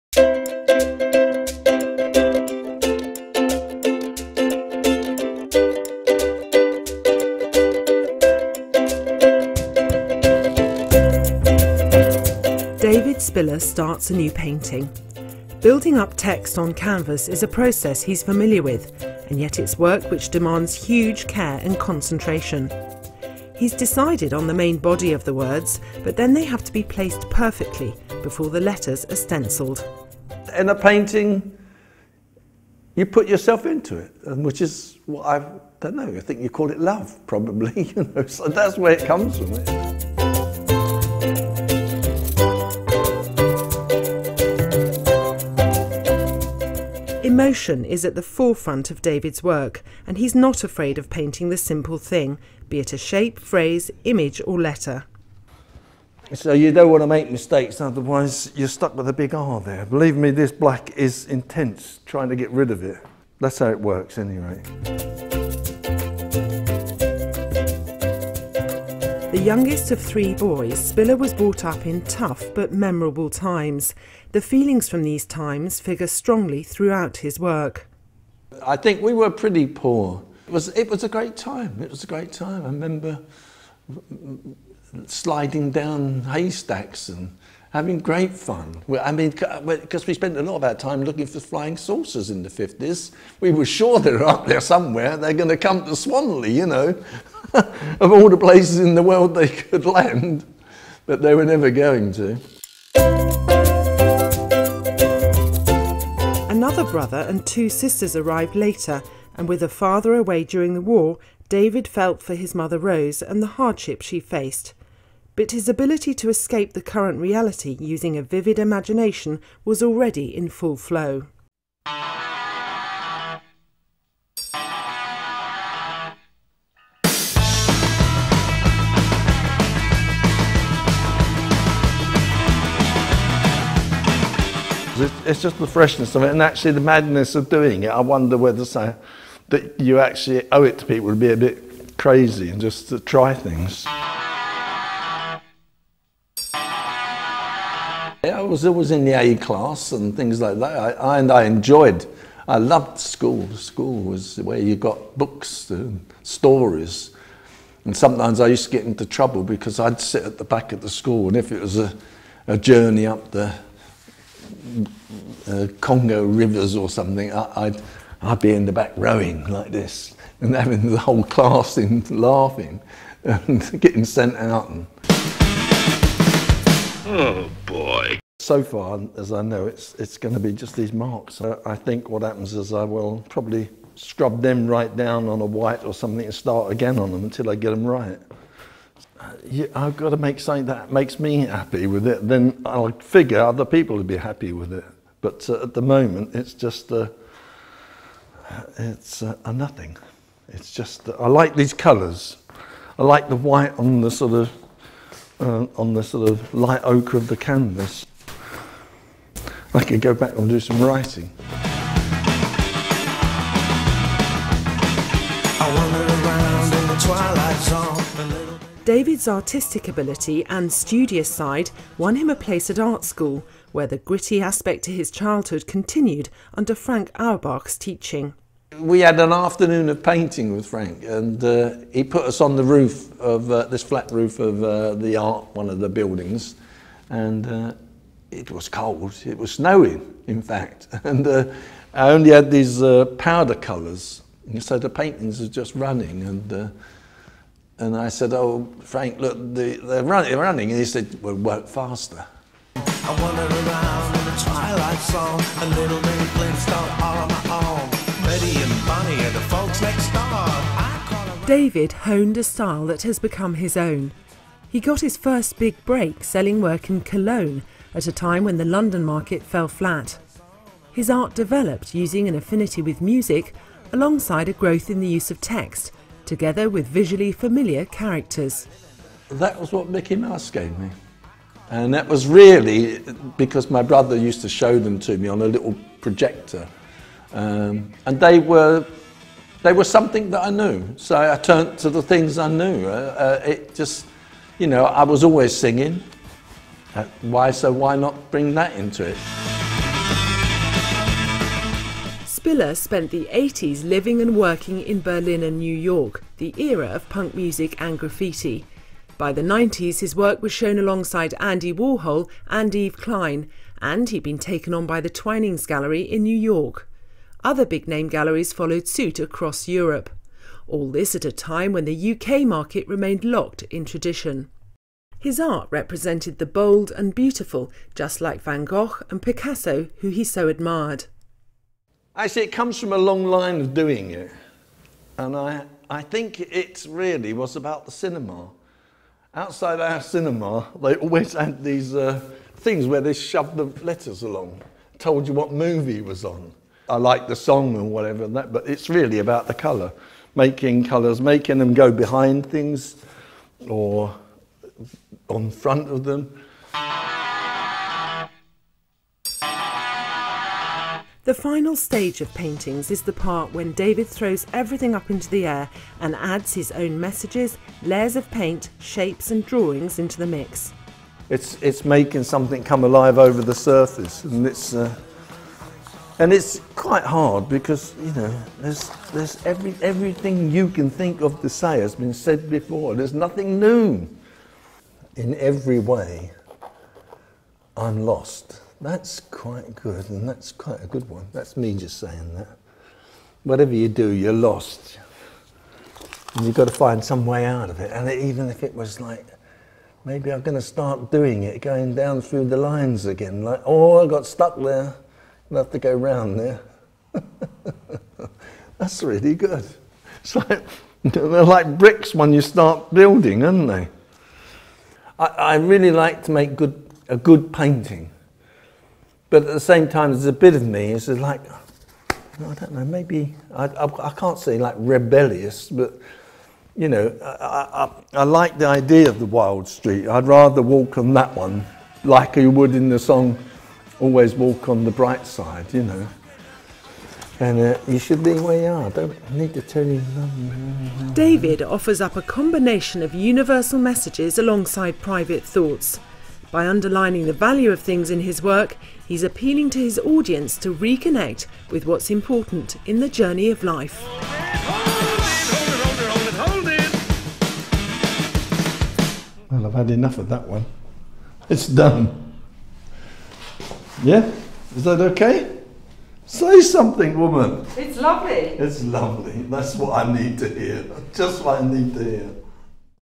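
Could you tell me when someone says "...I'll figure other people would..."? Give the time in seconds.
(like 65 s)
192 s.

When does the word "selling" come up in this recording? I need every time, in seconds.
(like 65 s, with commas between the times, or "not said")
266 s.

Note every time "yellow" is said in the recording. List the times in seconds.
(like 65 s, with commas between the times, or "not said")
not said.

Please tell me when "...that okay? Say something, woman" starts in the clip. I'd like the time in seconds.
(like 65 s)
464 s.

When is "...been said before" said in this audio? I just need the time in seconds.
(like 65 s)
381 s.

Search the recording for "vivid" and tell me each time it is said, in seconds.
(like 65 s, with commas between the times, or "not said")
118 s.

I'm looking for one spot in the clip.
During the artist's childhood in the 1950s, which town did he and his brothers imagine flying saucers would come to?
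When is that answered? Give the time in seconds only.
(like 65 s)
95 s.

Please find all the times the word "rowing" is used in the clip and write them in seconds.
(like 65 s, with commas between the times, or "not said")
168 s.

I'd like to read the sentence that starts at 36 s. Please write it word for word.
I think you call it love, probably.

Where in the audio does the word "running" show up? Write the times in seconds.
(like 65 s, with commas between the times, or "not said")
245 s, 250 s.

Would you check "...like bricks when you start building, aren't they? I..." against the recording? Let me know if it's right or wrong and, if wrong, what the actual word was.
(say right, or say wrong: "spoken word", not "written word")
right.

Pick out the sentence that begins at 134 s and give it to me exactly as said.
It's just the freshness of it, and actually the madness of doing it.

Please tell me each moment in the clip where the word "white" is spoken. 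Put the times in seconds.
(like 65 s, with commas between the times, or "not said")
185 s, 203 s.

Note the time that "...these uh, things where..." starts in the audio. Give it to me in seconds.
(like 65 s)
341 s.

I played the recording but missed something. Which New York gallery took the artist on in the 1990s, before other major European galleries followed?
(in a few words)
Twinings Gallery.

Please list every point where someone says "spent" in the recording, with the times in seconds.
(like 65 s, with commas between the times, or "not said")
90 s, 302 s.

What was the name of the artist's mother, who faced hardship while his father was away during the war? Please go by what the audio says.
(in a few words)
Rose.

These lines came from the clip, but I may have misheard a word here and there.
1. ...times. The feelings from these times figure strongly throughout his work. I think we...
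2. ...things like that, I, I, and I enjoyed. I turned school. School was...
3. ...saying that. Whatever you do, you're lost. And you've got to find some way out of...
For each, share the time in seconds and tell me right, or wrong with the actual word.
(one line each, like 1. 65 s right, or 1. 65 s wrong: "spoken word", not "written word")
1. 73 s right
2. 150 s wrong: "loved", not "turned"
3. 391 s right.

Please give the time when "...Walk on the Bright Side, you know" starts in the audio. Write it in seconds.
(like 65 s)
434 s.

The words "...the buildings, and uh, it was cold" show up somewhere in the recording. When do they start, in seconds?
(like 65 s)
235 s.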